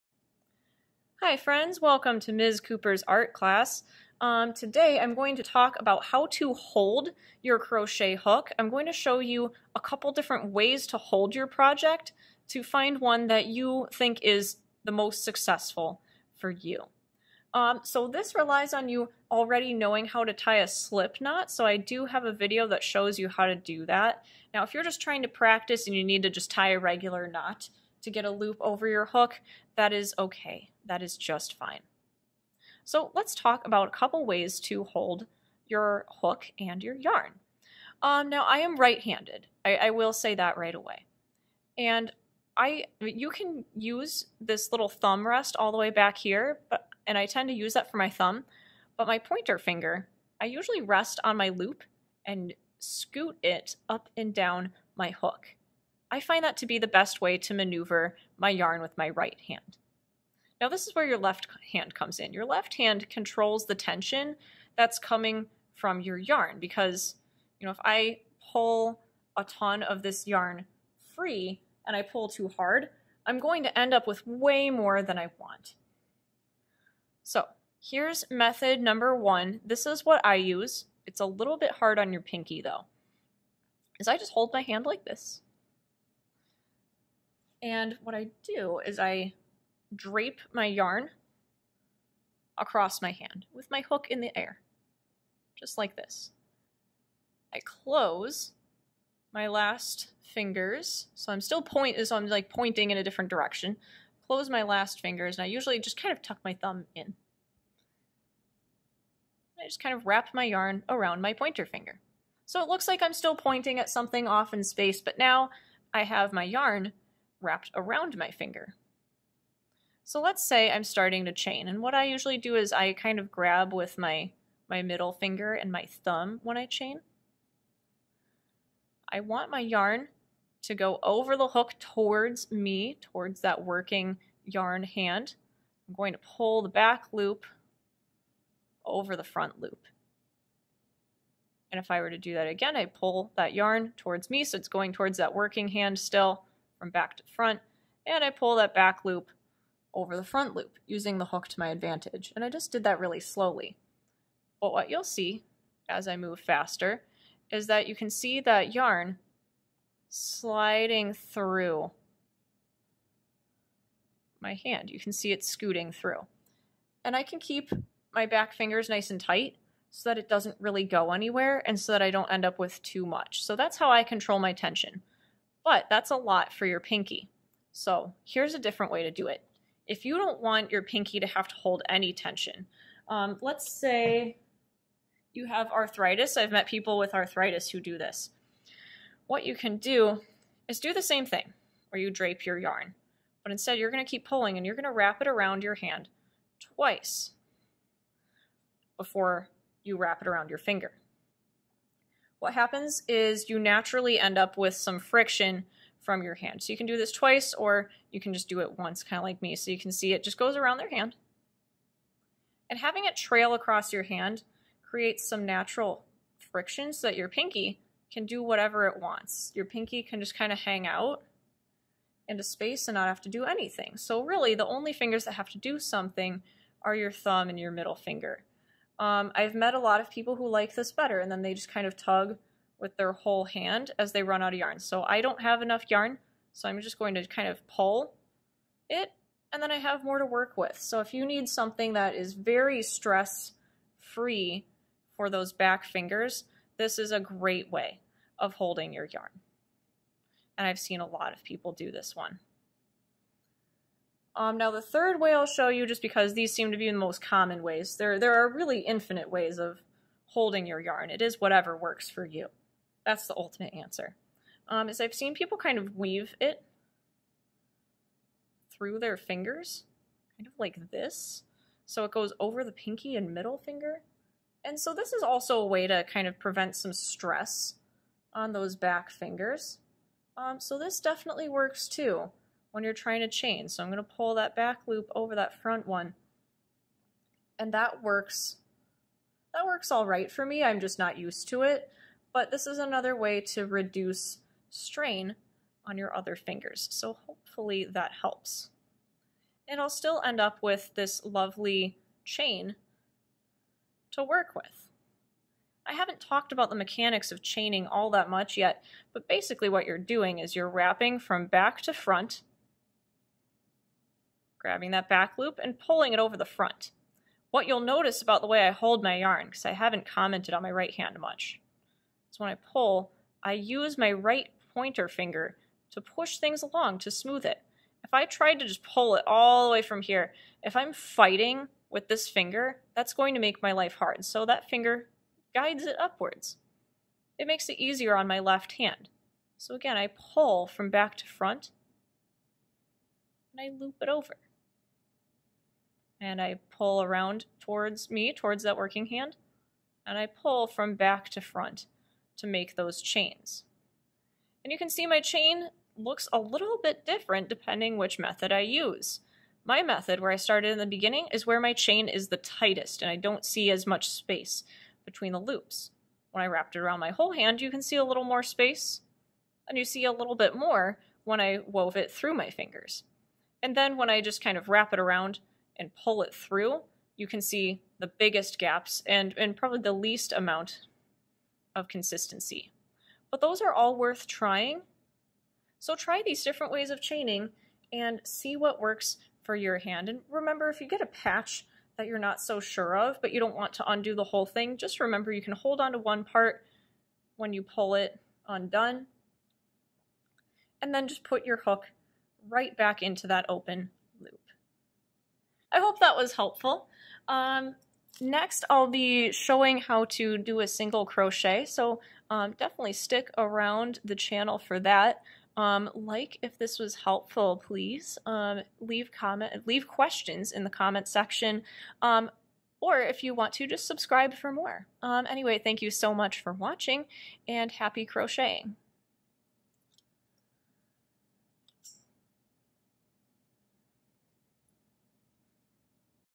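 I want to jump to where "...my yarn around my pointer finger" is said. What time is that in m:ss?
1:50.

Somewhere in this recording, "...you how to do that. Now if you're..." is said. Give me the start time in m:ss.
0:23.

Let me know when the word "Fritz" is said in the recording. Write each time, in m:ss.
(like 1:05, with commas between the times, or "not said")
not said.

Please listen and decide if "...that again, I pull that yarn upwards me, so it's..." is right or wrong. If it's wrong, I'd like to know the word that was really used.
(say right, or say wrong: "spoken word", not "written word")
wrong: "towards", not "upwards".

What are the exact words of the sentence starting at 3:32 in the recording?
And having it trail across your hand creates some natural friction so that your pinky can do whatever it wants.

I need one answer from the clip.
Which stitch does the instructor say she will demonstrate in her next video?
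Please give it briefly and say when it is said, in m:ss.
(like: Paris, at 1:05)
Single crochet, at 6:50.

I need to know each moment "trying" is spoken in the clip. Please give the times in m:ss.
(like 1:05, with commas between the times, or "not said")
0:25, 4:42, 6:24.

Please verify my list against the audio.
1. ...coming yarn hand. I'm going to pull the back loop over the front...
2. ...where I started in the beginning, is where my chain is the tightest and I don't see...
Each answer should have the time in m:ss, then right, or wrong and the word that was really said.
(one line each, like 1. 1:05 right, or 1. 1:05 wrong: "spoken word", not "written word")
1. 2:13 wrong: "working", not "coming"
2. 6:00 right.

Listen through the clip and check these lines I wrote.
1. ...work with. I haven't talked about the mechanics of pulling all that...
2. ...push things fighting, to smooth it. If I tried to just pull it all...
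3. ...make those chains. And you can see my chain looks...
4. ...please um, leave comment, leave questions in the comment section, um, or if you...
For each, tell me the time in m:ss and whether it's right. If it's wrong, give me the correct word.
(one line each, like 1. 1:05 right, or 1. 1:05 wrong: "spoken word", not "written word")
1. 5:04 wrong: "chaining", not "pulling"
2. 5:25 wrong: "along", not "fighting"
3. 5:52 right
4. 6:57 right.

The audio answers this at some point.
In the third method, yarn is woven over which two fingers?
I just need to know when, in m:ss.
4:32.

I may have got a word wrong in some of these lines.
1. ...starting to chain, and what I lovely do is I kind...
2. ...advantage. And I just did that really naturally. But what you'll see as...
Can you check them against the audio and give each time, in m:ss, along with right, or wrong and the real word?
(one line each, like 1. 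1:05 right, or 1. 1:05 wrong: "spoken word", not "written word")
1. 2:00 wrong: "usually", not "lovely"
2. 2:31 wrong: "slowly", not "naturally".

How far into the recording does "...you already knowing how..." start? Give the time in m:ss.
0:18.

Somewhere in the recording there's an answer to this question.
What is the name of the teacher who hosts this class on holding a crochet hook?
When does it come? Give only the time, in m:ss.
0:02.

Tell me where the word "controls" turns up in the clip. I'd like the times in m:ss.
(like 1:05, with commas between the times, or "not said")
1:03, 2:54.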